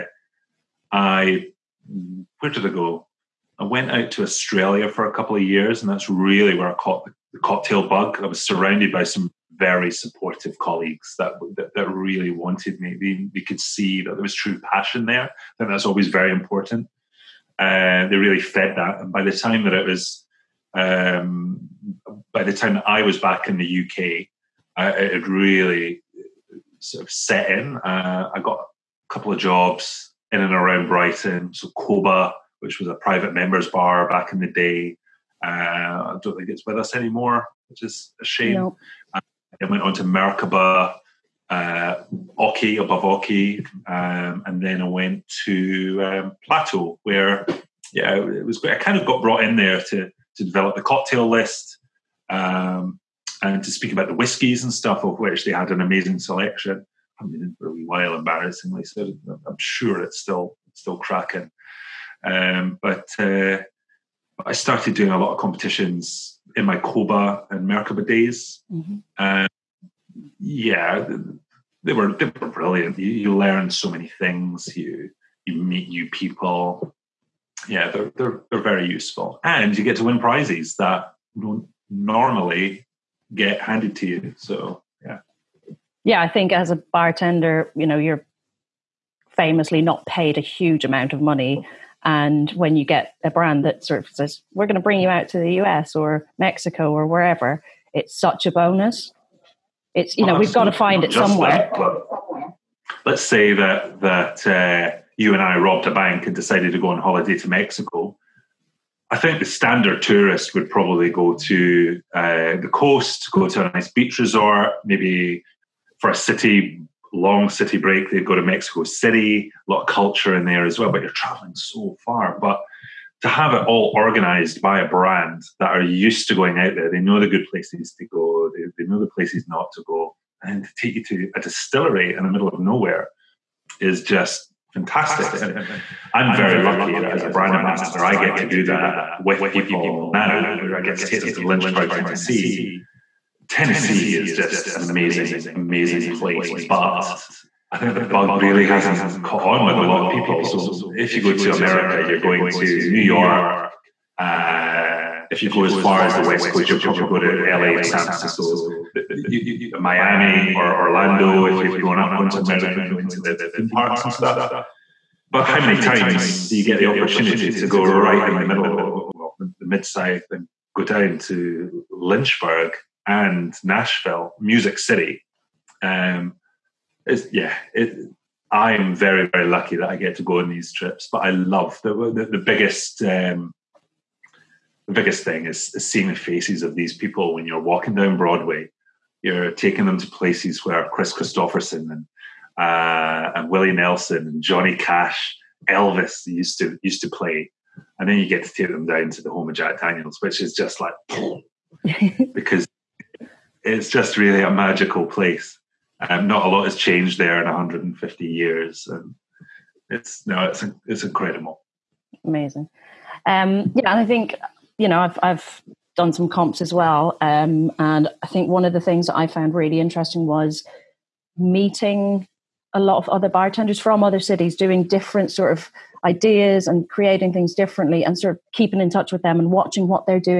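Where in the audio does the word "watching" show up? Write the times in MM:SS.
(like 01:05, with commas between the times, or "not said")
03:49.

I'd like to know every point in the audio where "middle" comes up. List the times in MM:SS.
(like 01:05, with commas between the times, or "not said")
02:12, 02:48.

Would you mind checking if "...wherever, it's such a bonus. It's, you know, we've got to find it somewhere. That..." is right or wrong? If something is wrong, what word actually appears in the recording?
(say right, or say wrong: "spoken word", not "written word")
right.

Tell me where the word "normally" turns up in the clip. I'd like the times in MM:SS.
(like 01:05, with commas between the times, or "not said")
01:21.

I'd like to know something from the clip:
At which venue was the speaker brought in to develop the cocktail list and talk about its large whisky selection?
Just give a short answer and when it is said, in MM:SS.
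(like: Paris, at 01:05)
Plateau, at 00:46.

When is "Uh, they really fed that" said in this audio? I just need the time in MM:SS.
00:17.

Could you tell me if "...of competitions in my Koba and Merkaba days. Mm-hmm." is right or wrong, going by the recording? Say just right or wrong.
right.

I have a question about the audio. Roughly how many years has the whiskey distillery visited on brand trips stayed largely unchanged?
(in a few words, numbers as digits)
150 years.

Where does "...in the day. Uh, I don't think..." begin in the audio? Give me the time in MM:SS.
00:34.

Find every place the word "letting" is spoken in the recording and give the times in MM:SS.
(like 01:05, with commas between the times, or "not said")
not said.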